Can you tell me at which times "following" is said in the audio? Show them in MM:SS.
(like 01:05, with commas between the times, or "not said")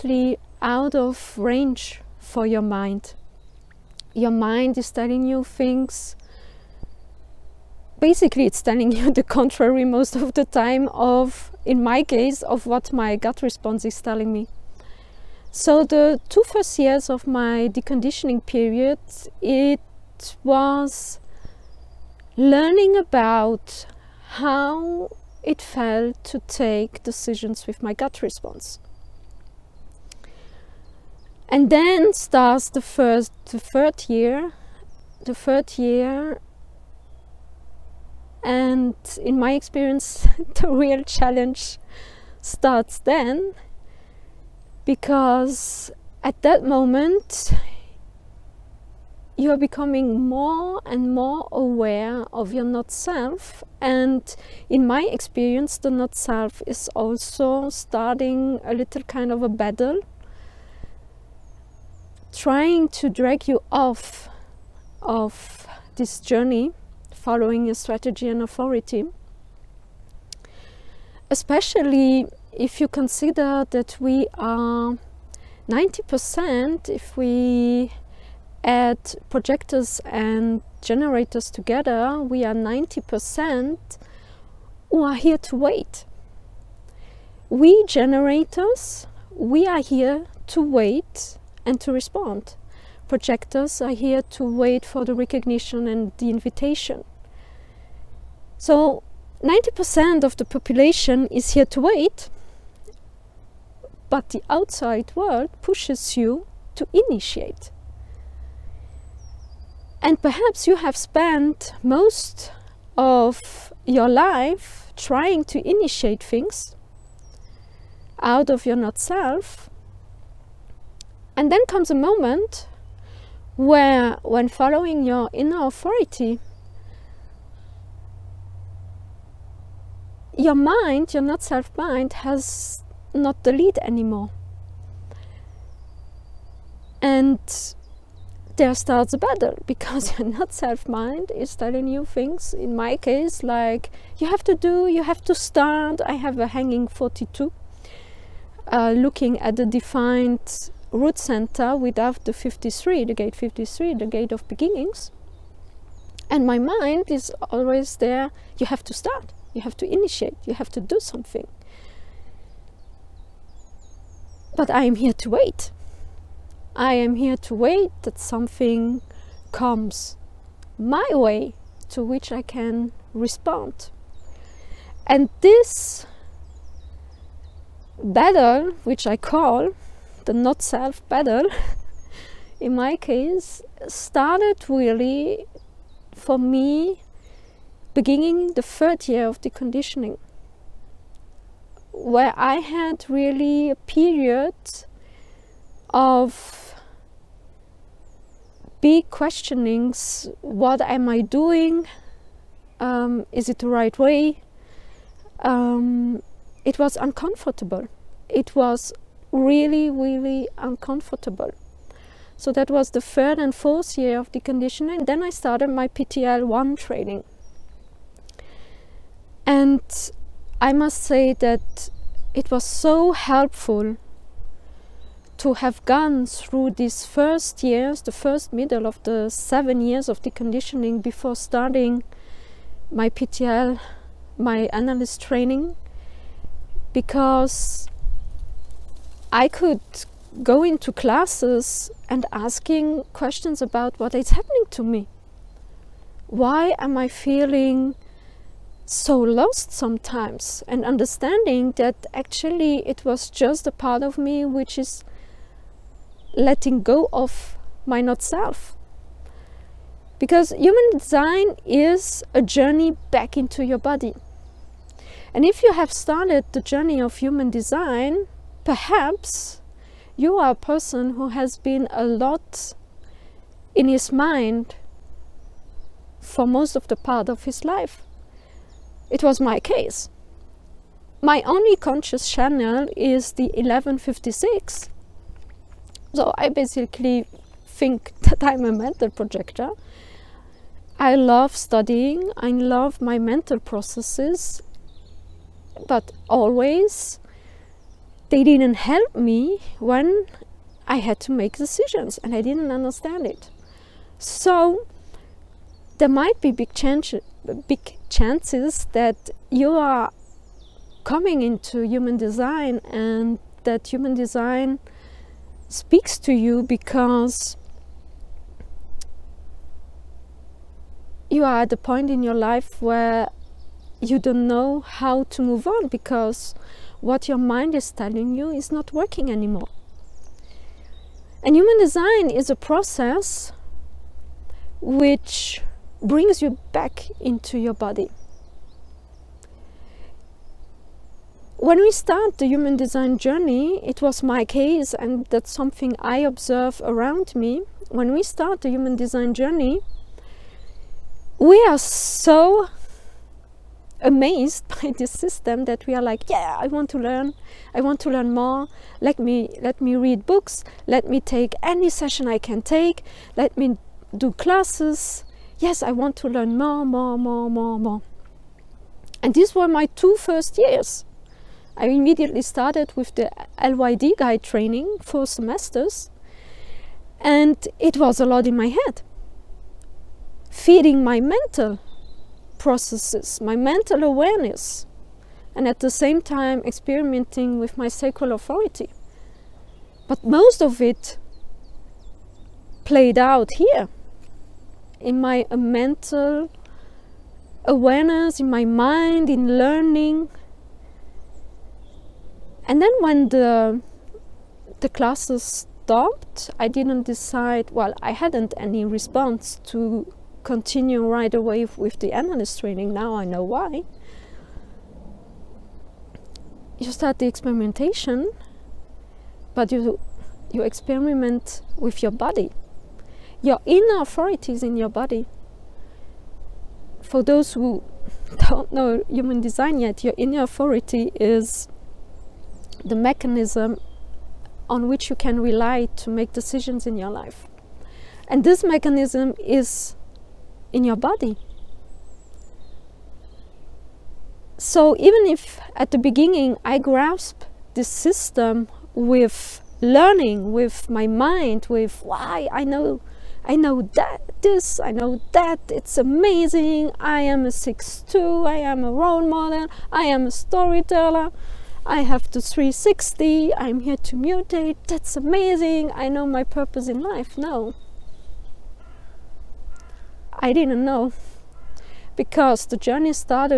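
01:07, 02:04.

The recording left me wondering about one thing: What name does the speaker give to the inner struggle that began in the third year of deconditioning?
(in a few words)
the not self battle.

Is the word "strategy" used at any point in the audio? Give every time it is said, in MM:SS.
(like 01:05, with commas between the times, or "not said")
01:07.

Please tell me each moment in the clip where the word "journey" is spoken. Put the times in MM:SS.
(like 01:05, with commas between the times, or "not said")
01:06, 04:22, 04:26, 05:43, 05:49, 07:52.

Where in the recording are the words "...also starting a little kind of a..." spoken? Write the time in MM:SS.
00:56.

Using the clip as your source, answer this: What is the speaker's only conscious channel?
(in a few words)
1156.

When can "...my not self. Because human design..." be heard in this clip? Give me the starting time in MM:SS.
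04:17.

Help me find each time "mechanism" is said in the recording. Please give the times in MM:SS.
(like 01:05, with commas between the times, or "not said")
07:12, 07:18.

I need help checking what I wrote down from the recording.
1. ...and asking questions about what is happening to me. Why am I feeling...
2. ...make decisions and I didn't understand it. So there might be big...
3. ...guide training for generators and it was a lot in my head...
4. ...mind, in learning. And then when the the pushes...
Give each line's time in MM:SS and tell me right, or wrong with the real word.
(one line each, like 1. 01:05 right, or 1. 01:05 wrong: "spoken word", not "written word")
1. 04:02 right
2. 05:01 right
3. 06:14 wrong: "semesters", not "generators"
4. 06:38 wrong: "classes", not "pushes".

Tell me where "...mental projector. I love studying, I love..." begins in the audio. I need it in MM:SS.
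04:48.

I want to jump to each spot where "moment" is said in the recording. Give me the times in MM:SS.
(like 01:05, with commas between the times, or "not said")
00:46, 02:01.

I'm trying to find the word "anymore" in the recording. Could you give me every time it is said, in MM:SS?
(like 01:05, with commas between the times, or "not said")
02:13, 05:29.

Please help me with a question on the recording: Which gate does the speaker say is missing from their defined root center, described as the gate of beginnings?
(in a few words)
53.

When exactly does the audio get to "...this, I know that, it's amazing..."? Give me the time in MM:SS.
07:34.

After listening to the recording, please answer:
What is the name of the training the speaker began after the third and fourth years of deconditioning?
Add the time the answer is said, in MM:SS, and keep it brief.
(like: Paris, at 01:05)
PTL 1, at 03:35.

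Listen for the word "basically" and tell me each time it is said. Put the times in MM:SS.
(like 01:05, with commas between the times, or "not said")
00:08, 04:46.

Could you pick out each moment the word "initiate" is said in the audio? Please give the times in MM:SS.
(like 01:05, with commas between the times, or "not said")
01:46, 01:55, 02:39.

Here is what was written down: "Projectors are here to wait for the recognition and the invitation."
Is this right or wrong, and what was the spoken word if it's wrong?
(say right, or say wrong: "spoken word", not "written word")
right.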